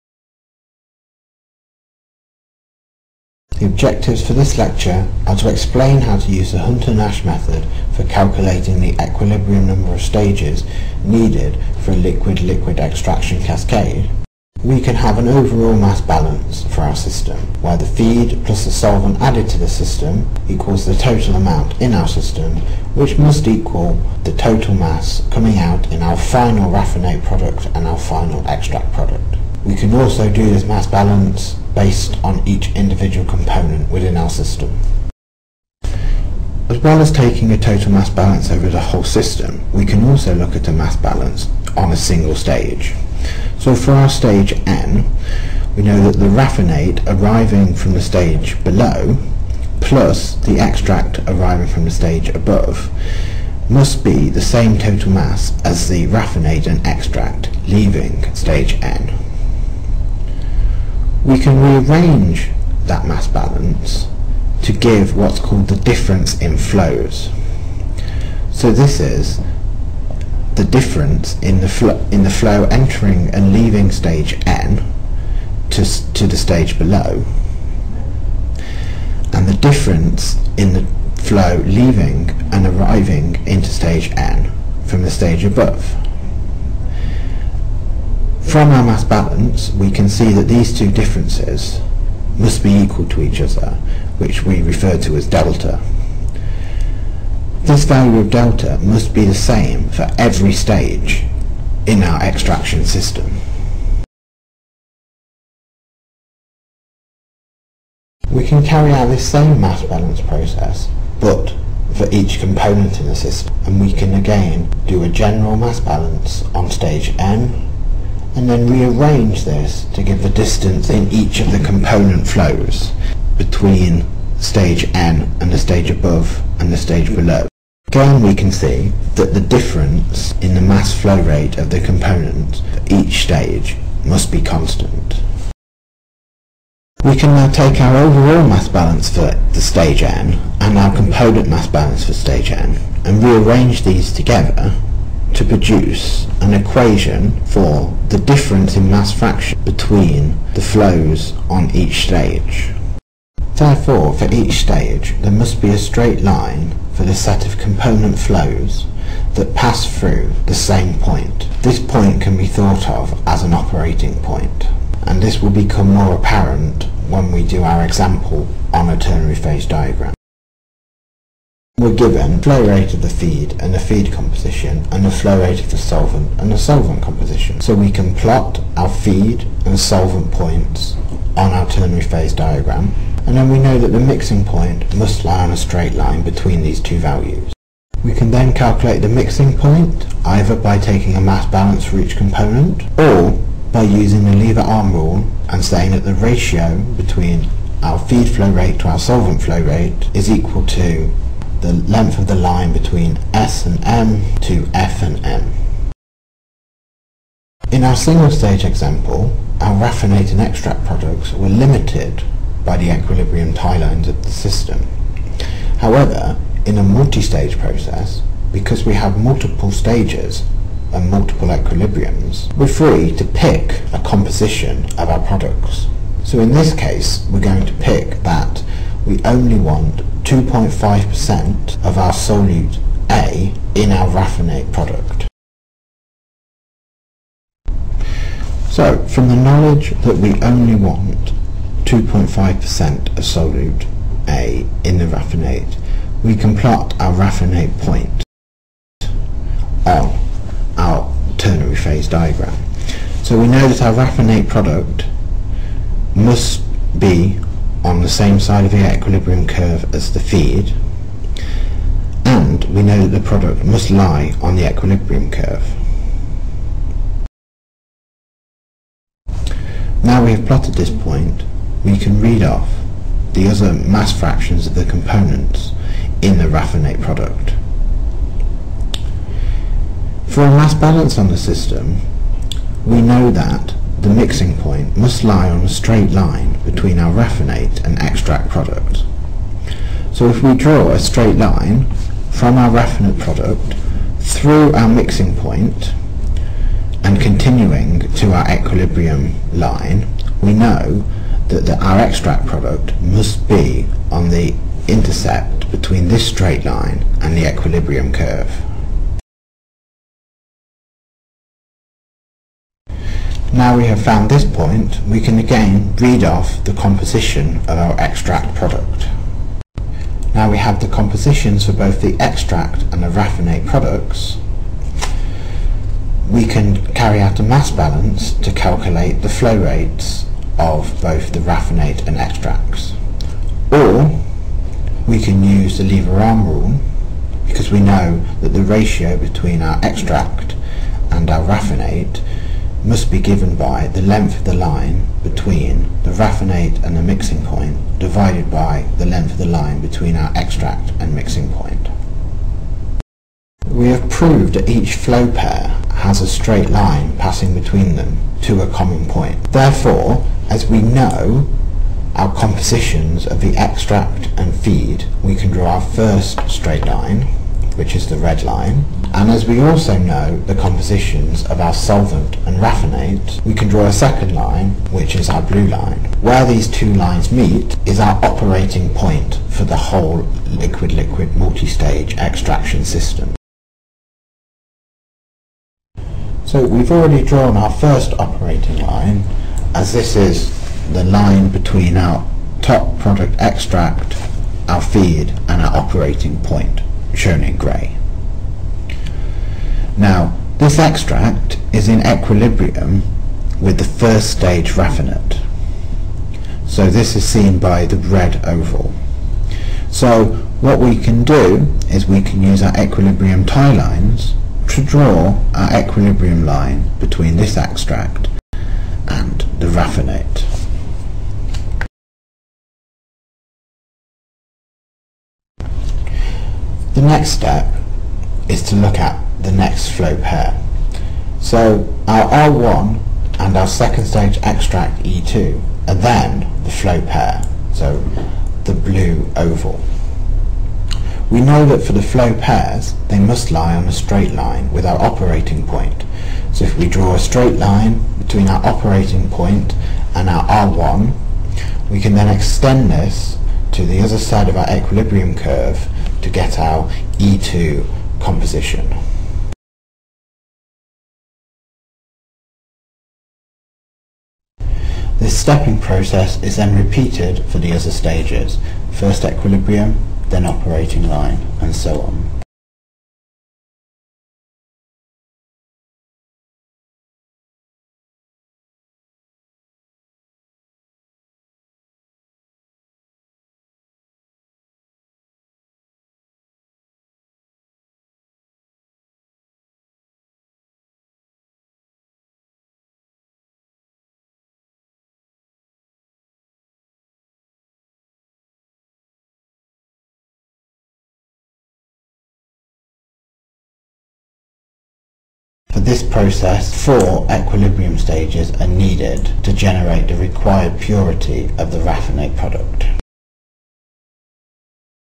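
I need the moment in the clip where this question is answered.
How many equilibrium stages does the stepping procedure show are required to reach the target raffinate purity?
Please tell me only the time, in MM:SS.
08:26.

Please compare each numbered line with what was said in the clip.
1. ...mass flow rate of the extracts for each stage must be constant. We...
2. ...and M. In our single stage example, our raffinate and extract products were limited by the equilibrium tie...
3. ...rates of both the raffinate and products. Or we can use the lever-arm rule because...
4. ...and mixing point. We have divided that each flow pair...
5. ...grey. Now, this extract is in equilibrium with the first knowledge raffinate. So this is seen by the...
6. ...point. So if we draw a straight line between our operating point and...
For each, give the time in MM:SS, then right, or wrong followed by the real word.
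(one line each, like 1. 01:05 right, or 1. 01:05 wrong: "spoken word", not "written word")
1. 02:10 wrong: "components", not "extracts"
2. 03:25 right
3. 05:29 wrong: "extracts", not "products"
4. 05:50 wrong: "proved", not "divided"
5. 06:37 wrong: "stage", not "knowledge"
6. 07:25 right.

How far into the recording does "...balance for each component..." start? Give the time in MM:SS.
03:11.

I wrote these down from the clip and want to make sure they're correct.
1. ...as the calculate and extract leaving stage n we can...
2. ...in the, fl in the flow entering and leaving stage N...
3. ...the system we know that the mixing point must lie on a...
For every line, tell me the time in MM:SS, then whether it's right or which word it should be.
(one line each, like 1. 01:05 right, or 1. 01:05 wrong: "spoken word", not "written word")
1. 00:55 wrong: "raffinate", not "calculate"
2. 01:11 right
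3. 04:41 right.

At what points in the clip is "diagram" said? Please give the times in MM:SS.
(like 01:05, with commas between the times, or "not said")
02:49, 03:02, 04:12.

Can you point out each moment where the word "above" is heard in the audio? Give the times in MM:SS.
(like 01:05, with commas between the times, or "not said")
00:52, 01:25, 02:05.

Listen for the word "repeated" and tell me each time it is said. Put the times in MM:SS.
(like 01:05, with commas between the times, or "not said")
07:46.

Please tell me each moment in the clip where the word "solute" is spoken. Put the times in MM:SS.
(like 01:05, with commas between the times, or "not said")
03:52, 04:03.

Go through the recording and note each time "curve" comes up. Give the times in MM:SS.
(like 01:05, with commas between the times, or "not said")
04:19, 04:25, 05:08, 07:35.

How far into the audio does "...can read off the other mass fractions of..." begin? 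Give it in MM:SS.
04:31.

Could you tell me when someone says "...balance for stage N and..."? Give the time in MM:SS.
02:21.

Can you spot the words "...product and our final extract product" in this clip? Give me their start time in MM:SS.
00:27.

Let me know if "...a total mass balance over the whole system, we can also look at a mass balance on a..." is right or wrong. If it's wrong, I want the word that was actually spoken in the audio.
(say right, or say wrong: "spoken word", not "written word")
right.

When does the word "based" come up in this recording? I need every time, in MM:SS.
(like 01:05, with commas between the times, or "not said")
00:31.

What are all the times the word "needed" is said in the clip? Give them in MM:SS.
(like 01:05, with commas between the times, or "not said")
00:11, 08:28.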